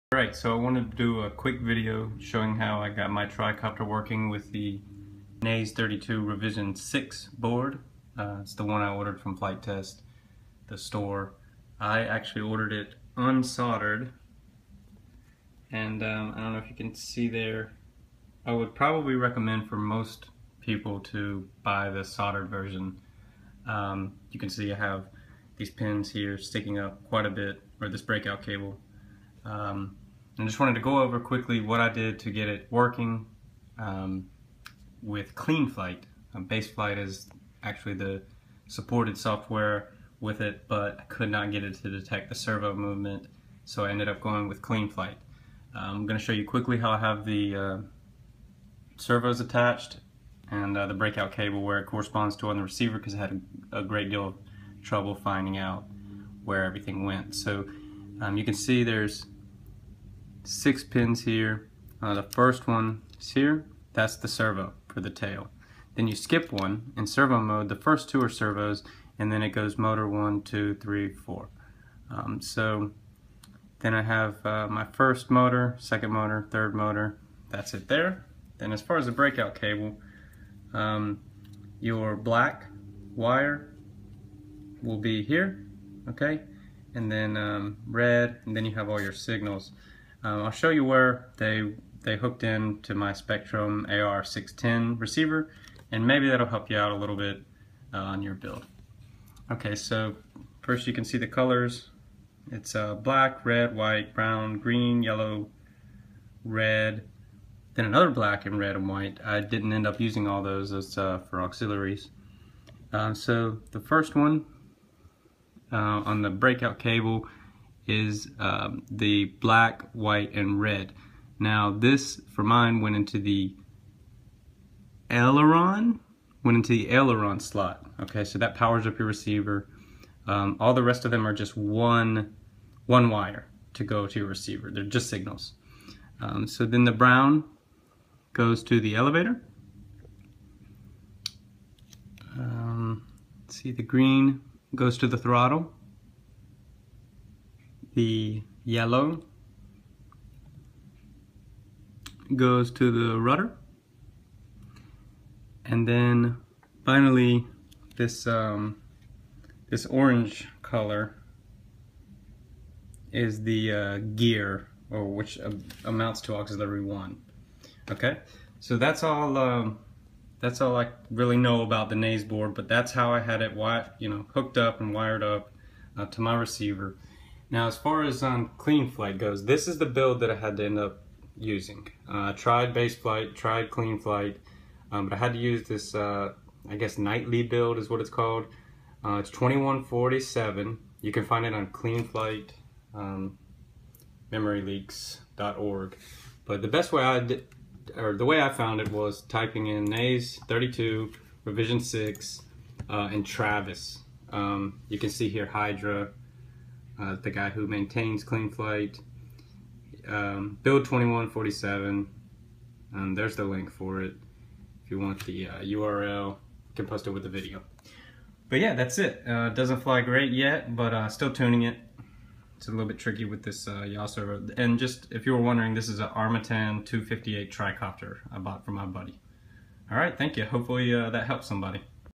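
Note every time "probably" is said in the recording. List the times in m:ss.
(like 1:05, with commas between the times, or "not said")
0:18.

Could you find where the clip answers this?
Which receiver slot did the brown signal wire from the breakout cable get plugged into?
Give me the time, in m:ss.
2:18.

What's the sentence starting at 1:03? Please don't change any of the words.
That's the servo for the tail.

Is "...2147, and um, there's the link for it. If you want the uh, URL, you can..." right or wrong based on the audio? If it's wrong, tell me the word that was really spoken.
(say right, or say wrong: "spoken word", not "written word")
right.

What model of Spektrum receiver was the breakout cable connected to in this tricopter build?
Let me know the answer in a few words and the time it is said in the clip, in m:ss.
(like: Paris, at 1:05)
AR610, at 1:33.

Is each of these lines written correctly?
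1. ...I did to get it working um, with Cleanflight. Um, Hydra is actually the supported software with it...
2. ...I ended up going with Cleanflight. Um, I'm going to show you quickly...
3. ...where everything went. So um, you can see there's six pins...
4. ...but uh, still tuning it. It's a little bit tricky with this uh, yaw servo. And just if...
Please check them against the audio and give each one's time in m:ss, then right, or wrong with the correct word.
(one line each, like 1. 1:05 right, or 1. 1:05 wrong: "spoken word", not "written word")
1. 0:31 wrong: "Baseflight", not "Hydra"
2. 0:43 right
3. 0:56 right
4. 3:40 right.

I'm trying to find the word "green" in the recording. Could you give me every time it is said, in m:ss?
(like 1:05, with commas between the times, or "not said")
1:44, 2:23.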